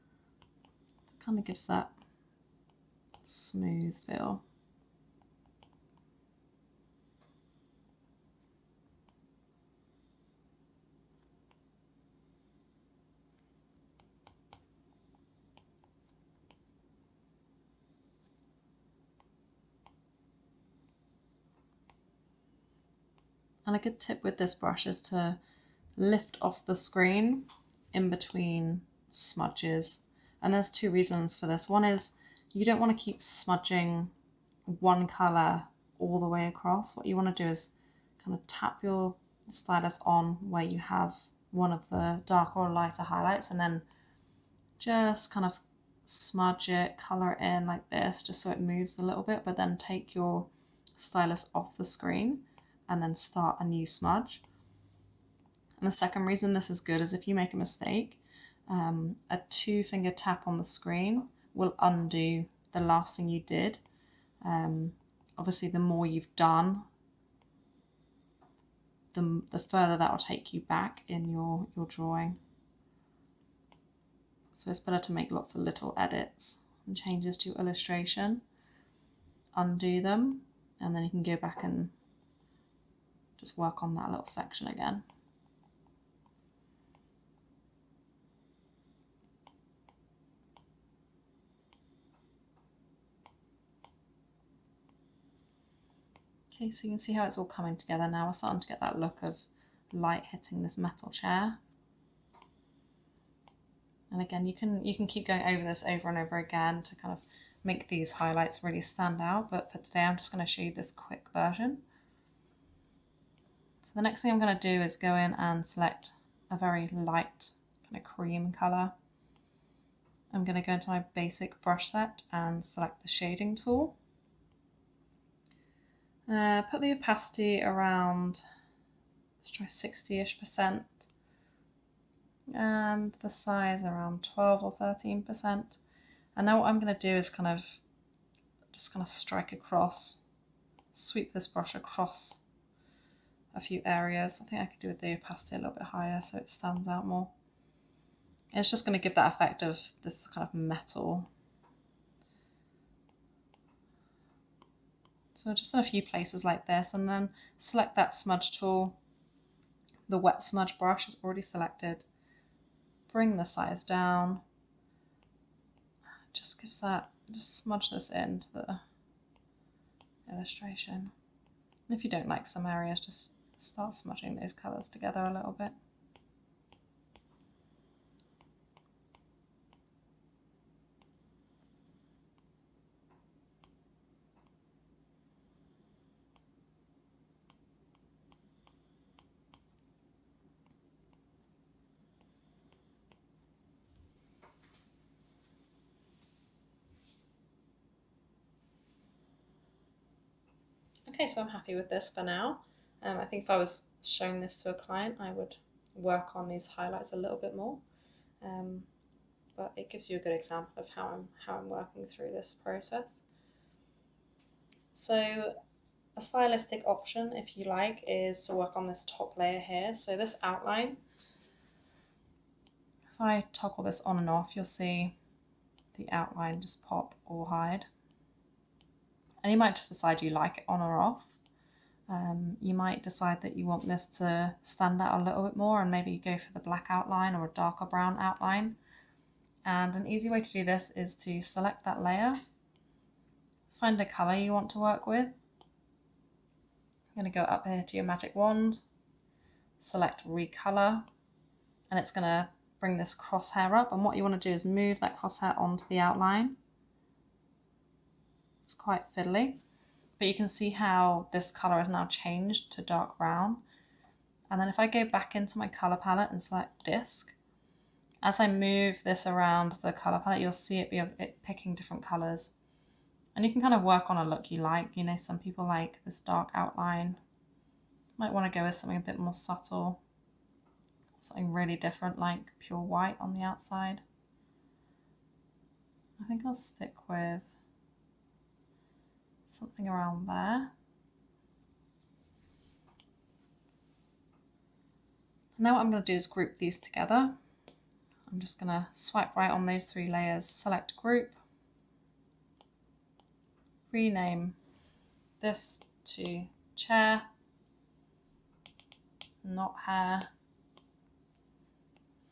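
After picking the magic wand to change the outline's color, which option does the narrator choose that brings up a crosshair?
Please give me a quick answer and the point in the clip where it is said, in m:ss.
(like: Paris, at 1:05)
recolor, at 4:10.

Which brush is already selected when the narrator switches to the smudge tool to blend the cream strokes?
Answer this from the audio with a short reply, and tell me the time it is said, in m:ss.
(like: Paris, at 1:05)
wet smudge brush, at 2:40.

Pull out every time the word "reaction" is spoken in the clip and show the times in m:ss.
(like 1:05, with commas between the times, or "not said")
not said.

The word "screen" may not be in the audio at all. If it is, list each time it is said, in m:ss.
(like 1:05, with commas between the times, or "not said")
0:26, 0:51, 1:00.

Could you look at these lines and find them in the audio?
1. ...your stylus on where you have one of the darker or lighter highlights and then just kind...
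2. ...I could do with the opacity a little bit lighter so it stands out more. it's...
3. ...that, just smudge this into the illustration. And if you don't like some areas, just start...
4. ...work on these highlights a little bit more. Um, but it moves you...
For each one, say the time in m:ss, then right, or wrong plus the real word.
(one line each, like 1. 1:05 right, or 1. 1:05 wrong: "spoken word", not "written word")
1. 0:38 right
2. 2:24 wrong: "higher", not "lighter"
3. 2:46 right
4. 3:25 wrong: "gives", not "moves".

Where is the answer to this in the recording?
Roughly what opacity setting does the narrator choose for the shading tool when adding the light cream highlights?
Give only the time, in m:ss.
2:09.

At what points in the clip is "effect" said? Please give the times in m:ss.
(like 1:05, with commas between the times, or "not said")
2:29.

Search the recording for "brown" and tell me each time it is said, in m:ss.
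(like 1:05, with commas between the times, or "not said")
3:57, 4:23.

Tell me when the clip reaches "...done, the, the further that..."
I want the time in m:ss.
1:06.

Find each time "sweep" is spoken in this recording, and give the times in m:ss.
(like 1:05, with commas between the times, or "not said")
2:20.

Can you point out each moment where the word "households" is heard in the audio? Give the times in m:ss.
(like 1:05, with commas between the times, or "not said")
not said.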